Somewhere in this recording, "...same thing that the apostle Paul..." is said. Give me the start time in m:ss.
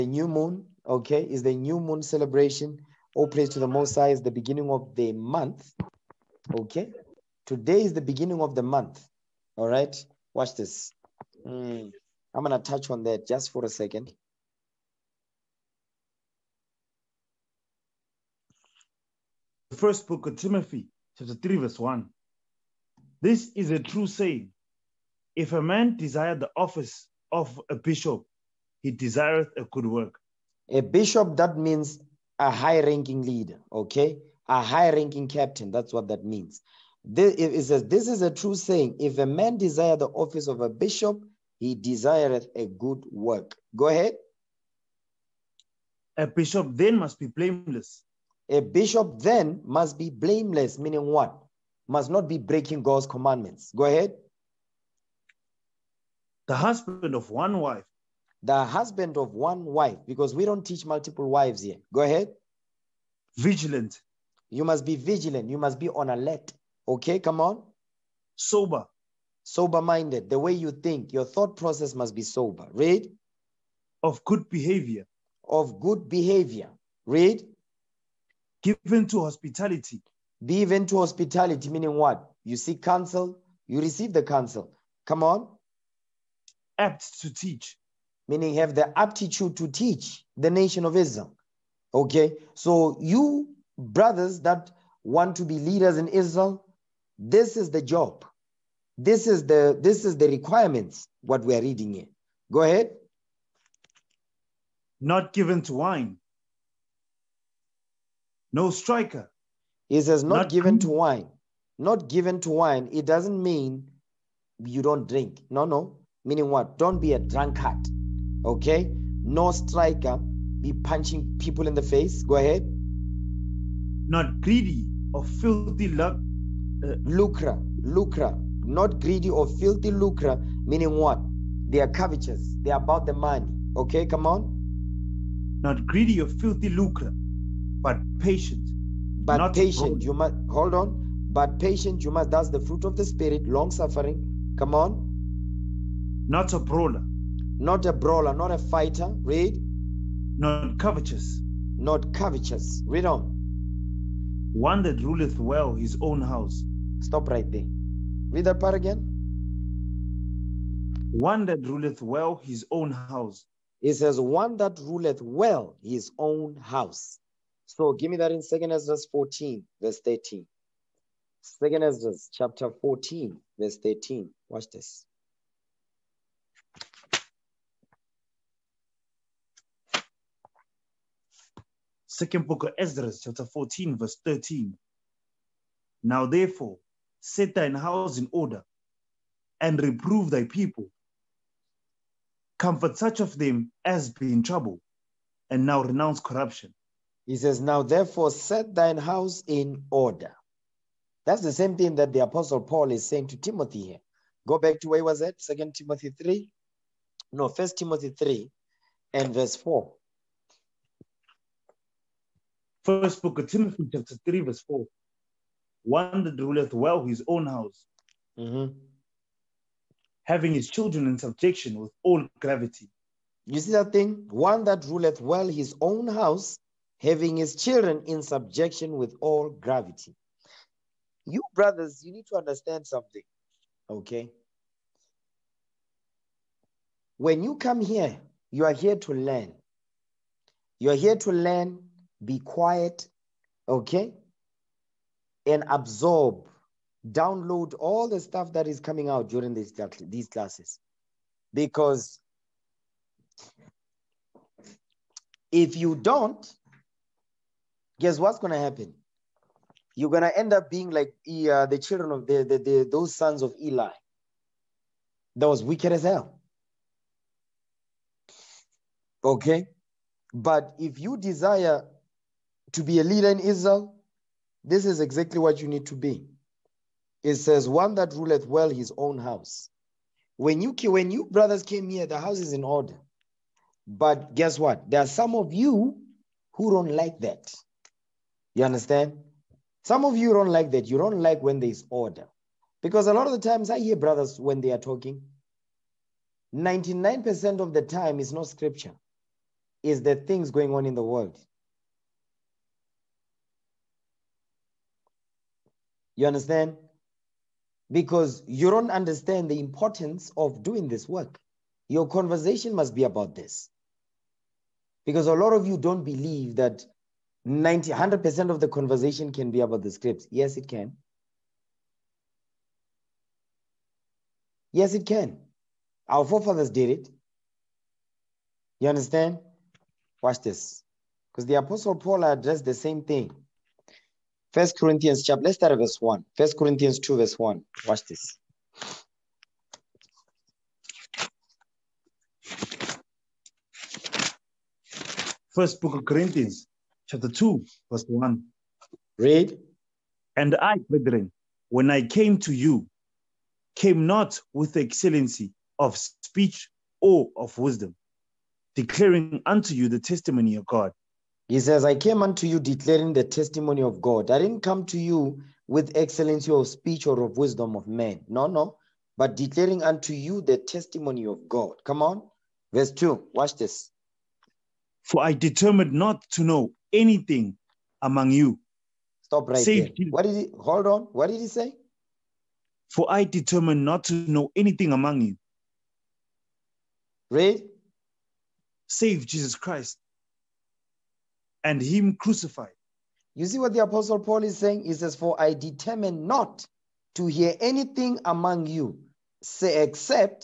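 3:21.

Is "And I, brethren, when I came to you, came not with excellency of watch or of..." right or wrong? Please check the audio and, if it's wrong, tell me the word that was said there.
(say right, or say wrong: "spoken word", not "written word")
wrong: "speech", not "watch".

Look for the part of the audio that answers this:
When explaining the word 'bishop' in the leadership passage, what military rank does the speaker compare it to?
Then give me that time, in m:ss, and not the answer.
0:34.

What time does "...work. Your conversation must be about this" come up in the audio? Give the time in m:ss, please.
5:11.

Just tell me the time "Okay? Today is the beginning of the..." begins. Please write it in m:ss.
0:06.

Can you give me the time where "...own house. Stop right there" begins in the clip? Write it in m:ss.
2:35.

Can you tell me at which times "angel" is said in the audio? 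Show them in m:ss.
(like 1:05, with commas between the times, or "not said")
not said.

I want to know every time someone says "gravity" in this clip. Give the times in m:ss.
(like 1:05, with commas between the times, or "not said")
3:42, 3:49.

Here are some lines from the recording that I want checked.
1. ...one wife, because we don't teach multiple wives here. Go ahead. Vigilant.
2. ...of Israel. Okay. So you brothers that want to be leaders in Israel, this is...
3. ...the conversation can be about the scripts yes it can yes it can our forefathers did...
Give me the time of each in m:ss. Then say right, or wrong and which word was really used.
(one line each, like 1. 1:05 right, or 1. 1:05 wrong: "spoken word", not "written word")
1. 0:59 right
2. 1:30 right
3. 5:18 right.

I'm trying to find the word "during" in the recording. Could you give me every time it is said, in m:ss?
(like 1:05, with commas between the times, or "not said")
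4:09.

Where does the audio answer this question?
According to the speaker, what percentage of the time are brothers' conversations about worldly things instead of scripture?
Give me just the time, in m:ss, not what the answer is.
4:56.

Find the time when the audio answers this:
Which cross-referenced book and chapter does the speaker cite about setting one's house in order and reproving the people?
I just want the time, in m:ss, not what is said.
2:48.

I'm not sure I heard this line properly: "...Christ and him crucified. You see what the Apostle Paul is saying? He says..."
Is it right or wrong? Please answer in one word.
right.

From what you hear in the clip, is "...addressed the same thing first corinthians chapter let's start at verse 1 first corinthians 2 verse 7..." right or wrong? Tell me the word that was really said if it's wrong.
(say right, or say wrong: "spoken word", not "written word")
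wrong: "1", not "7".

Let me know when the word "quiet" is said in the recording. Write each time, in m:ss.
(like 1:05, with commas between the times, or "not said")
4:02.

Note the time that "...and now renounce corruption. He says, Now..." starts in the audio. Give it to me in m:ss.
3:15.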